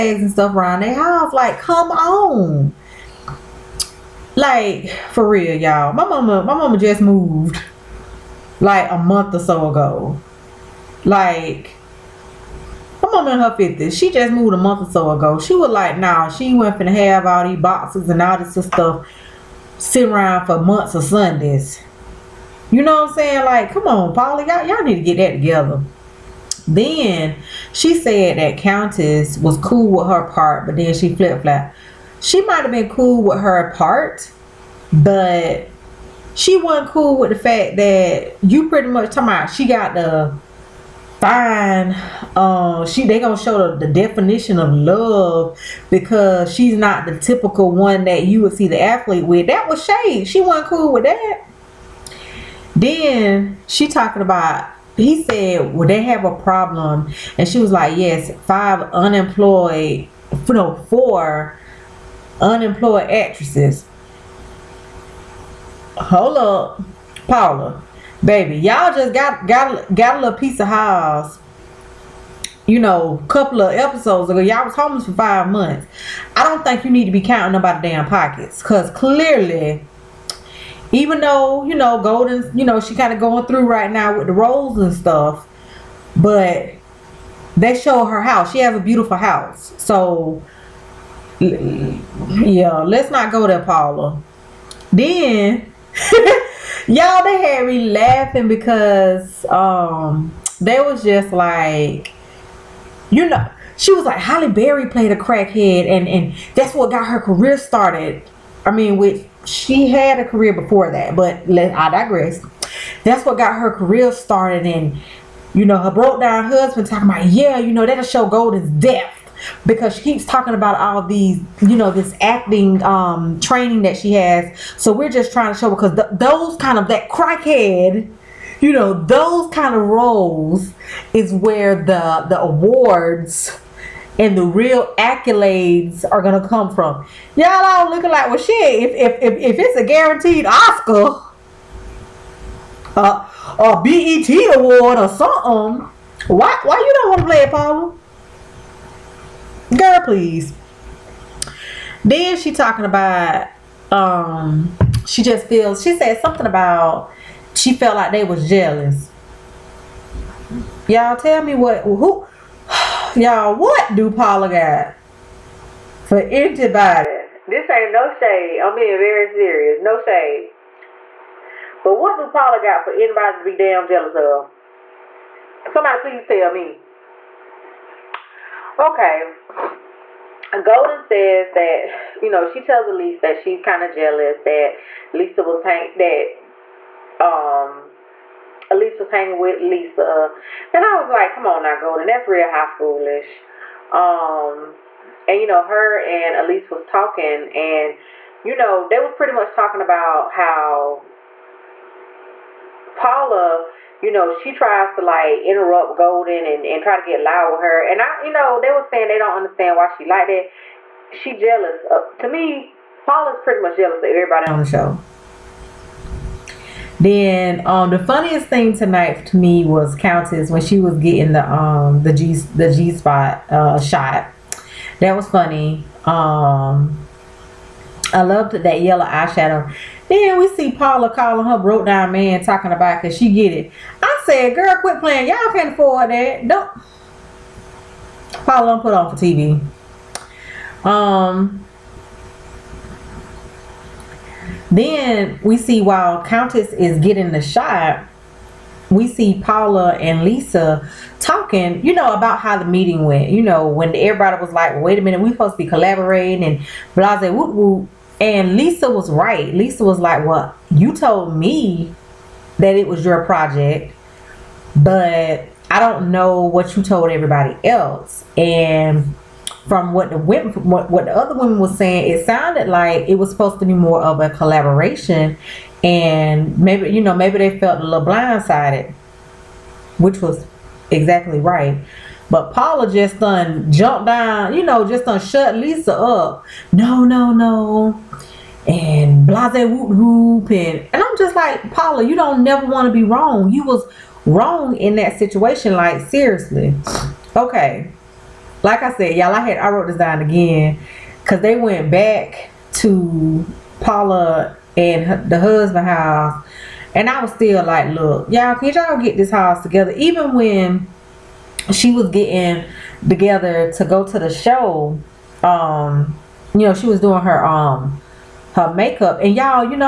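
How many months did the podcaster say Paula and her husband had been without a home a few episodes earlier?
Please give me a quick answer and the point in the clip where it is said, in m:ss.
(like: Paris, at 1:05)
5, at 1:15.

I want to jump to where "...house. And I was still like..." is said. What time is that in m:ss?
5:05.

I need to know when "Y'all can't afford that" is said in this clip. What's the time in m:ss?
3:55.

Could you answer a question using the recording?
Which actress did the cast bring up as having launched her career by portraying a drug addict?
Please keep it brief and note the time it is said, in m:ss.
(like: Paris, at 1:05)
Halle Berry, at 1:44.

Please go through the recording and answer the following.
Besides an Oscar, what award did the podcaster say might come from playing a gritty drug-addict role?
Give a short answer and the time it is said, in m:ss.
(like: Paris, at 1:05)
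BET award, at 2:23.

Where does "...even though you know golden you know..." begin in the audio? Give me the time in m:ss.
1:20.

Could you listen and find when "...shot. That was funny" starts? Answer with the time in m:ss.
3:43.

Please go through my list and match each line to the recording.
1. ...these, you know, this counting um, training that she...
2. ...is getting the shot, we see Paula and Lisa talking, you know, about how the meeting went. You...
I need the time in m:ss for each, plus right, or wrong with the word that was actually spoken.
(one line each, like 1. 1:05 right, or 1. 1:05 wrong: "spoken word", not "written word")
1. 2:01 wrong: "acting", not "counting"
2. 4:06 right.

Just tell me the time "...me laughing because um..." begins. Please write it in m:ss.
1:37.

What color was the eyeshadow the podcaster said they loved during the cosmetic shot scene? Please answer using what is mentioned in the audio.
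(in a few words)
Yellow.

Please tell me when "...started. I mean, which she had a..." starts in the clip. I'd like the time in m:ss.
1:47.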